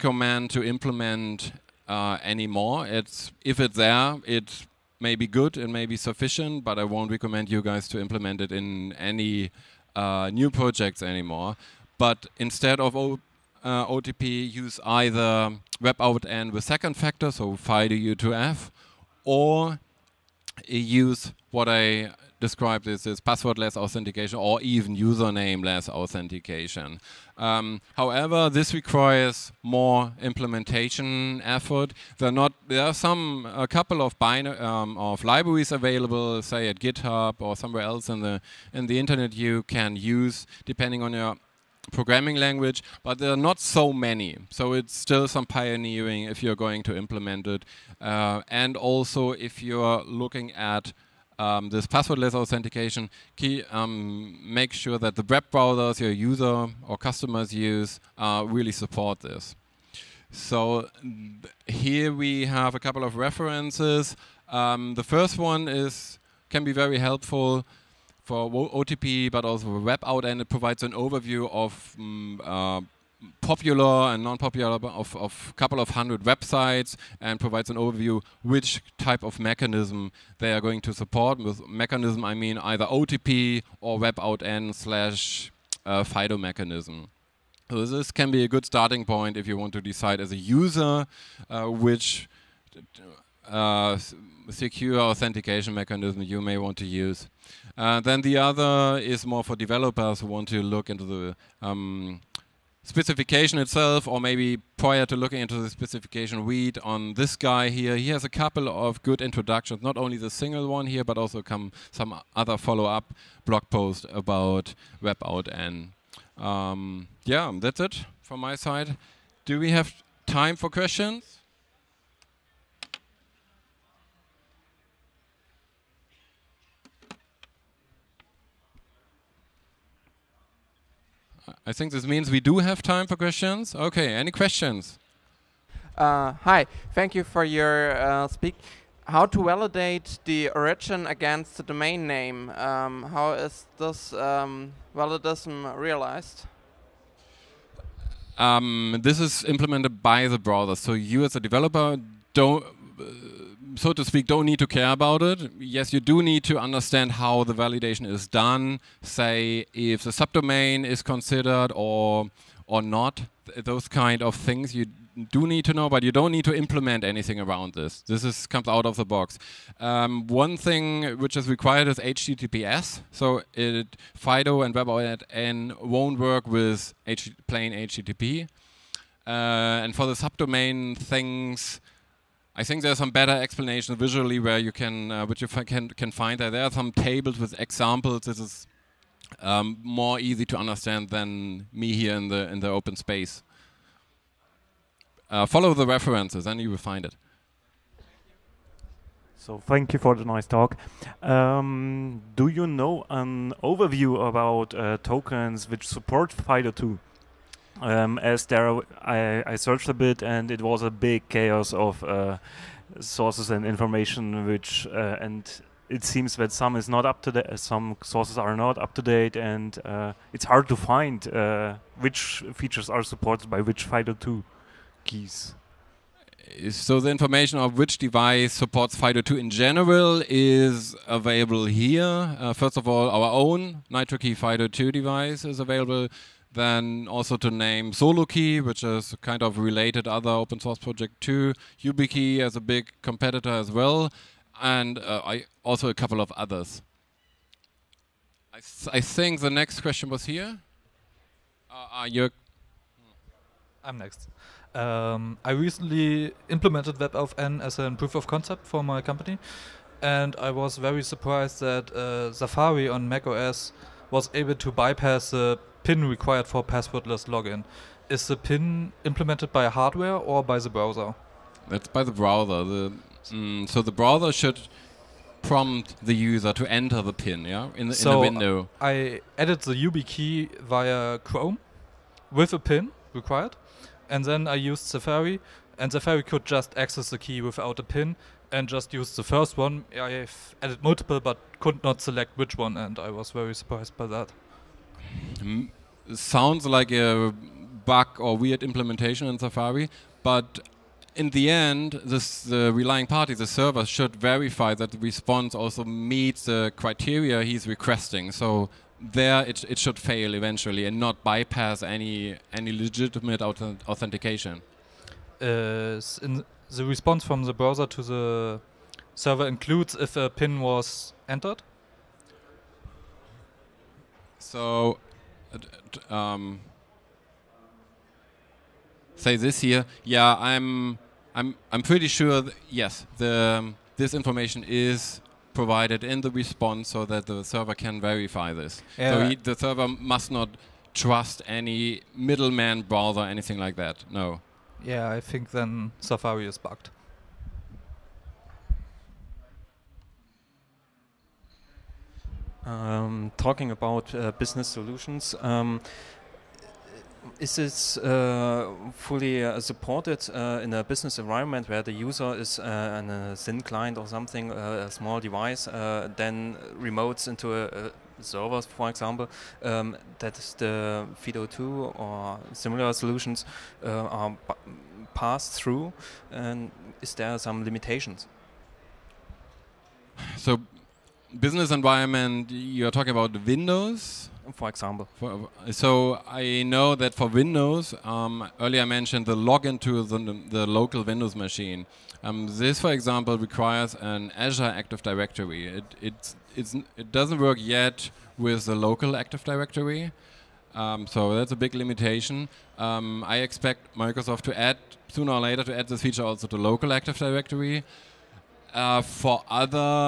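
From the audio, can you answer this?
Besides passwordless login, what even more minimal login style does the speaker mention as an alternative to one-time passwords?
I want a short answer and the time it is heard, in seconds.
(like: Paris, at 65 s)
Usernameless authentication, at 24 s.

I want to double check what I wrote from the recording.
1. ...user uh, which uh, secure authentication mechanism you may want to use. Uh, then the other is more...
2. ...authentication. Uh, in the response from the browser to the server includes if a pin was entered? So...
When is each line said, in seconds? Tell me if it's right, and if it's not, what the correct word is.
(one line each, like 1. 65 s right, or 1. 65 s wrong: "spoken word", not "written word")
1. 90 s right
2. 313 s right.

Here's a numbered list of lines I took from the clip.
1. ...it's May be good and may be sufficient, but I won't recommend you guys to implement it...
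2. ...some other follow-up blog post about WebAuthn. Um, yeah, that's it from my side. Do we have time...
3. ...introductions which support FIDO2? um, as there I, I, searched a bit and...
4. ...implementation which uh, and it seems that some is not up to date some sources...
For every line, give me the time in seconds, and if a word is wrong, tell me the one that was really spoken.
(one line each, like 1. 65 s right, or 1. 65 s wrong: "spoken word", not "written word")
1. 4 s right
2. 111 s right
3. 205 s wrong: "tokens", not "introductions"
4. 213 s wrong: "information", not "implementation".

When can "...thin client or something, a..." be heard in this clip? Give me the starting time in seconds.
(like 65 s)
363 s.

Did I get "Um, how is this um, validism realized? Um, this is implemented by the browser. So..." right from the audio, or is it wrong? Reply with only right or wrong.
right.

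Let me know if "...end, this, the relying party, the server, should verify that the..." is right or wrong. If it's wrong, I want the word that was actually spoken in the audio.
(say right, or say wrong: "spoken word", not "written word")
right.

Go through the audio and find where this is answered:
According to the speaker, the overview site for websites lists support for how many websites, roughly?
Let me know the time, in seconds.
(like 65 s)
75 s.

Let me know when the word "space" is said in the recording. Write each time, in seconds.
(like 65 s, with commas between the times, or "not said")
192 s.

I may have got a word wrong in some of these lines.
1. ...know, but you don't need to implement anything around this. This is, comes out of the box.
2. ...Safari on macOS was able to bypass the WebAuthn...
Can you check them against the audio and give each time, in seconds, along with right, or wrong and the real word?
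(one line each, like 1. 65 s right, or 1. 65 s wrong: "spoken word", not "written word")
1. 165 s right
2. 262 s wrong: "PIN", not "WebAuthn".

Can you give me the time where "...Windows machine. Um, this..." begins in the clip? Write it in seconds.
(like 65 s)
391 s.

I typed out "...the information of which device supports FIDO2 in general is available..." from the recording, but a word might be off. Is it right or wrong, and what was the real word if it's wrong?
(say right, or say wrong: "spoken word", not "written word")
right.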